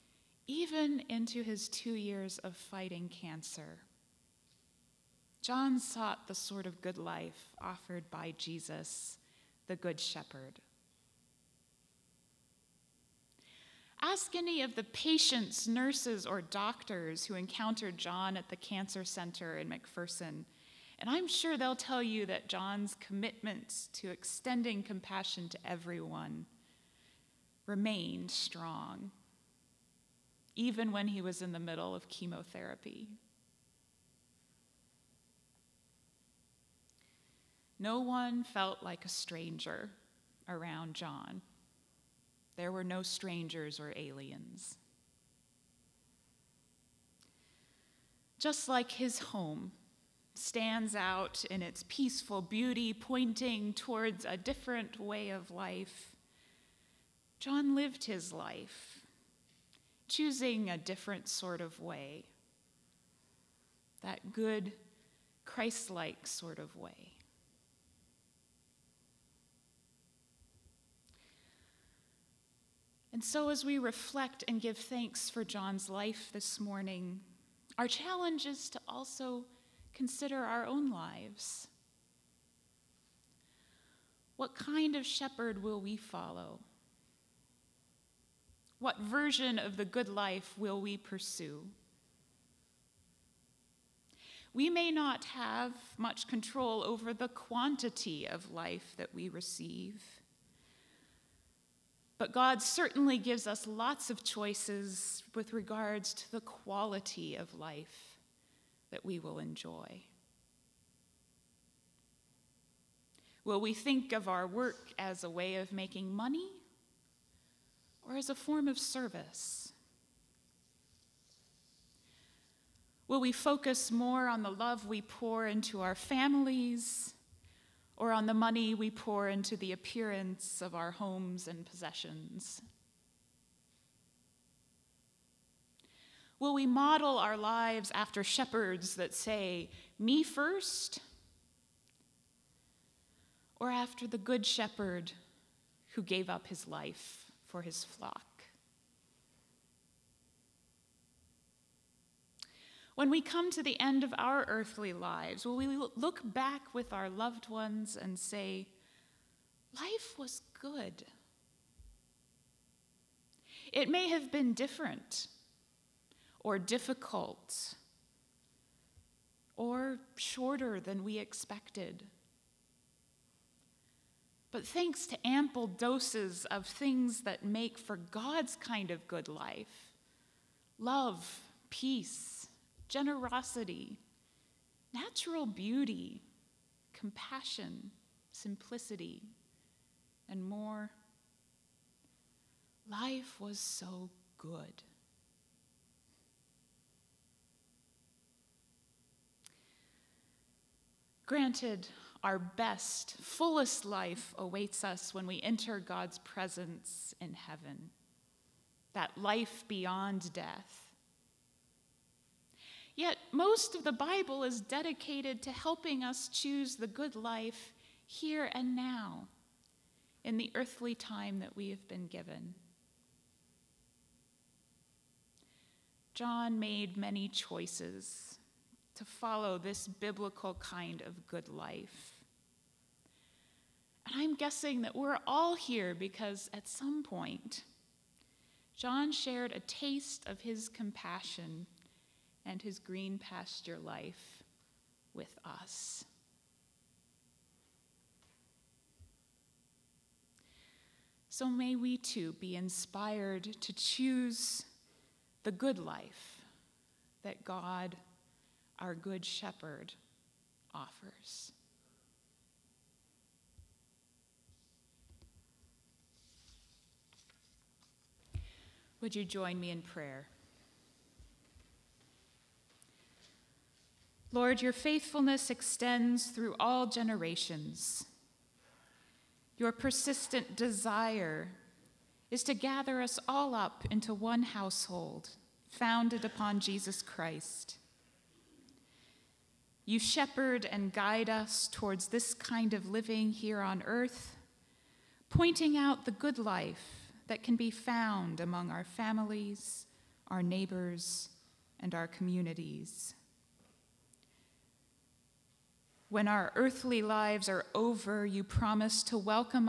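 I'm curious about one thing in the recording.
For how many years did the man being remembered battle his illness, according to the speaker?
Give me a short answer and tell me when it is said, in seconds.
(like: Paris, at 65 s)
2, at 1 s.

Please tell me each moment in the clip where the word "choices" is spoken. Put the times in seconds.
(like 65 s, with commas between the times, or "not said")
104 s, 227 s.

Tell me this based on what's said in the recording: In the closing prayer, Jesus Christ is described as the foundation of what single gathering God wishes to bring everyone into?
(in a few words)
one household.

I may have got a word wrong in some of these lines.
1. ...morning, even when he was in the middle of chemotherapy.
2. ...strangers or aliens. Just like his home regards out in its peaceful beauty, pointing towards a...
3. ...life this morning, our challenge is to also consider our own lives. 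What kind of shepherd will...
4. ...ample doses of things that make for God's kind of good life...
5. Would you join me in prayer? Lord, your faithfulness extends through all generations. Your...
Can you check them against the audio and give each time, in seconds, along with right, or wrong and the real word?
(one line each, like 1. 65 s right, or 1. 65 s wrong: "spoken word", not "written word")
1. 28 s wrong: "strong", not "morning"
2. 43 s wrong: "stands", not "regards"
3. 75 s right
4. 175 s right
5. 269 s right.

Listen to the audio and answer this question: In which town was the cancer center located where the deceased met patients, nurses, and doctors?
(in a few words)
McPherson.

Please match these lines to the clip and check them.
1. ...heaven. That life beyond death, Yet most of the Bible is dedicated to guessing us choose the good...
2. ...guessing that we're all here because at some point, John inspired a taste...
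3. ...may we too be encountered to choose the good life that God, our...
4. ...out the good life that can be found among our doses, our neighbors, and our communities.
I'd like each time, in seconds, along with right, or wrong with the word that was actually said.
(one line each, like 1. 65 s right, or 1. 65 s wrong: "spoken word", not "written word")
1. 207 s wrong: "helping", not "guessing"
2. 234 s wrong: "shared", not "inspired"
3. 251 s wrong: "inspired", not "encountered"
4. 295 s wrong: "families", not "doses".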